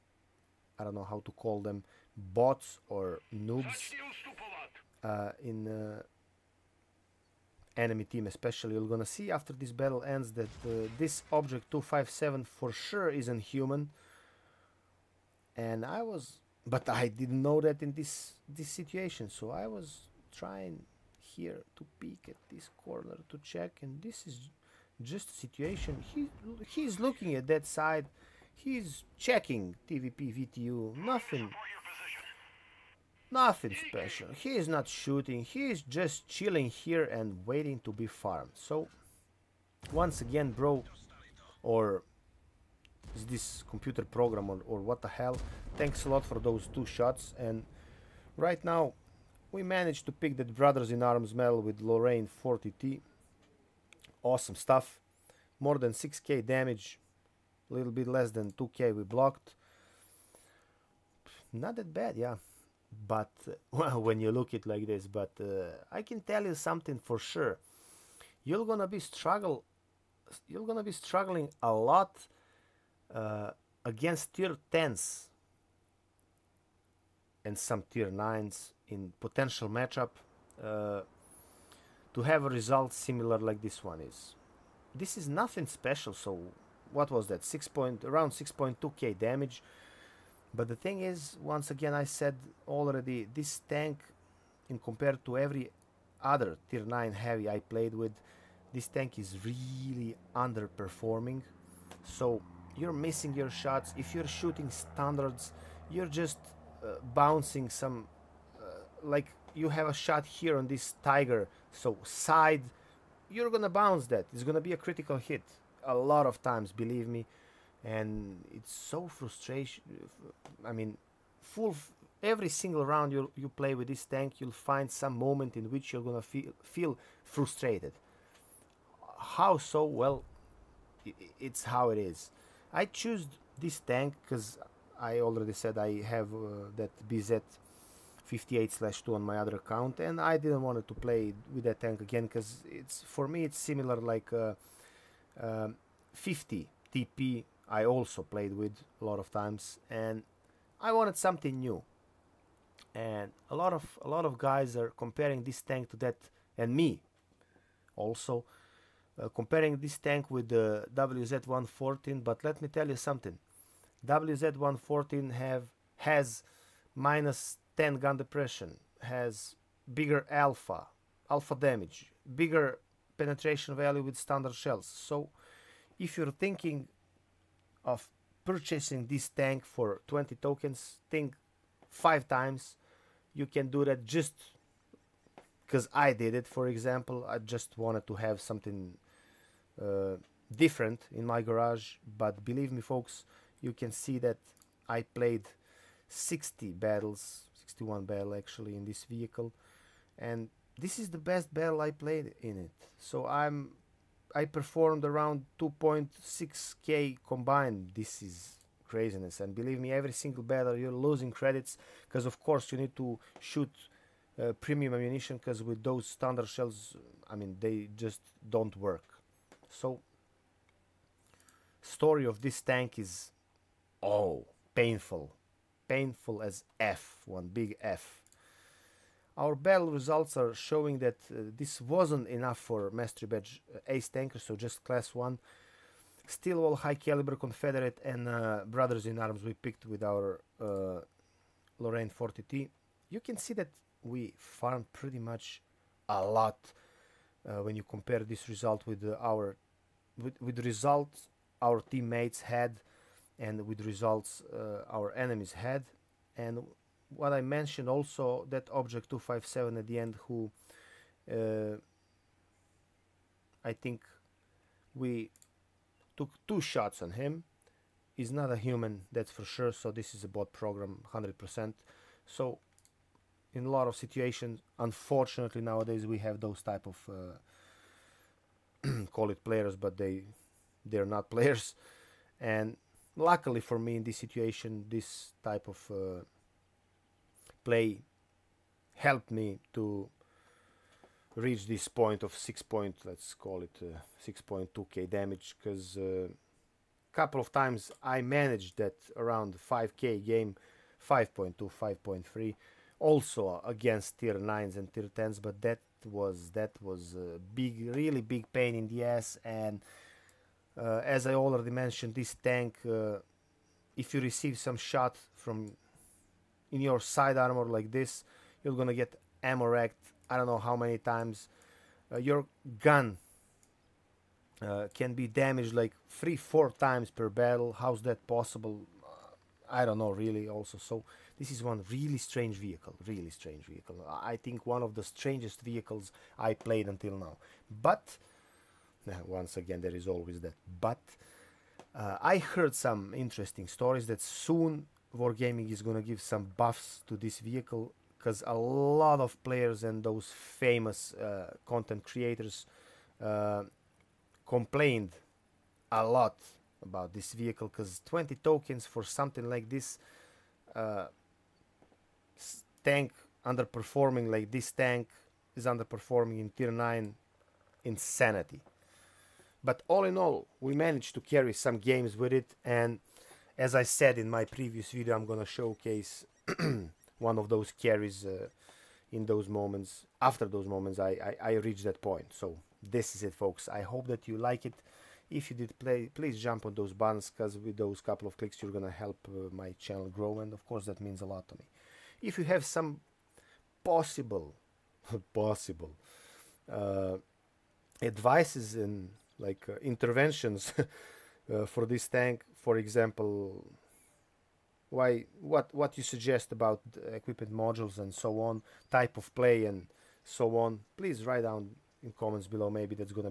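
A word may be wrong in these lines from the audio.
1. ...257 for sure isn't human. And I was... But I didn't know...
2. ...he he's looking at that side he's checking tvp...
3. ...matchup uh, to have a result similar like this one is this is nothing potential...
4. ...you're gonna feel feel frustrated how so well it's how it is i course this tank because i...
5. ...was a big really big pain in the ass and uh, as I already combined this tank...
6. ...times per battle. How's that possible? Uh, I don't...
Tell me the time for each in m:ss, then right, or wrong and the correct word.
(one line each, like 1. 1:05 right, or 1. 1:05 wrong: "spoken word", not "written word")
1. 0:11 right
2. 0:26 right
3. 1:19 wrong: "special", not "potential"
4. 2:05 wrong: "choose", not "course"
5. 5:06 wrong: "mentioned", not "combined"
6. 5:26 right.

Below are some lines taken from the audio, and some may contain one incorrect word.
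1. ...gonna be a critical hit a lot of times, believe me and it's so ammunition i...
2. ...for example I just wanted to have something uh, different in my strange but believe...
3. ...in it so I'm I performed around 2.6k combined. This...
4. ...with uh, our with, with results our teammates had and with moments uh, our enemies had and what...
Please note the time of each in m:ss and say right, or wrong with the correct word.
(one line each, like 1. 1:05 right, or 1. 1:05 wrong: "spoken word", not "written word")
1. 1:54 wrong: "frustration", not "ammunition"
2. 3:06 wrong: "garage", not "strange"
3. 3:22 right
4. 4:08 wrong: "results", not "moments".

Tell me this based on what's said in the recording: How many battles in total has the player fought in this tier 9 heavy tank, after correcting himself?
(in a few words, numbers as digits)
61.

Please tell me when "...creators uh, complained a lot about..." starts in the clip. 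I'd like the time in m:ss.
5:52.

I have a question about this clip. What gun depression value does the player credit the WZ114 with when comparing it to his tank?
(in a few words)
-10.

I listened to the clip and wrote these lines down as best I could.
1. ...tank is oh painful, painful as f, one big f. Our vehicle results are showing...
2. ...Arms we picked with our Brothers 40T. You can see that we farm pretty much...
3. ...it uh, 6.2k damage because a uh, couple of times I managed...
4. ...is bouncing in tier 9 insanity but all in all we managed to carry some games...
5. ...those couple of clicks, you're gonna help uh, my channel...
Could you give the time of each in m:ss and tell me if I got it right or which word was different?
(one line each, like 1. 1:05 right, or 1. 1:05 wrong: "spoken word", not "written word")
1. 3:42 wrong: "battle", not "vehicle"
2. 3:59 wrong: "Lorraine", not "Brothers"
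3. 4:53 right
4. 6:05 wrong: "underperforming", not "bouncing"
5. 6:27 right.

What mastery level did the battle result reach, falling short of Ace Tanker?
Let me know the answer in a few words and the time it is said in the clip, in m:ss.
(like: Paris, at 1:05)
Class 1, at 3:54.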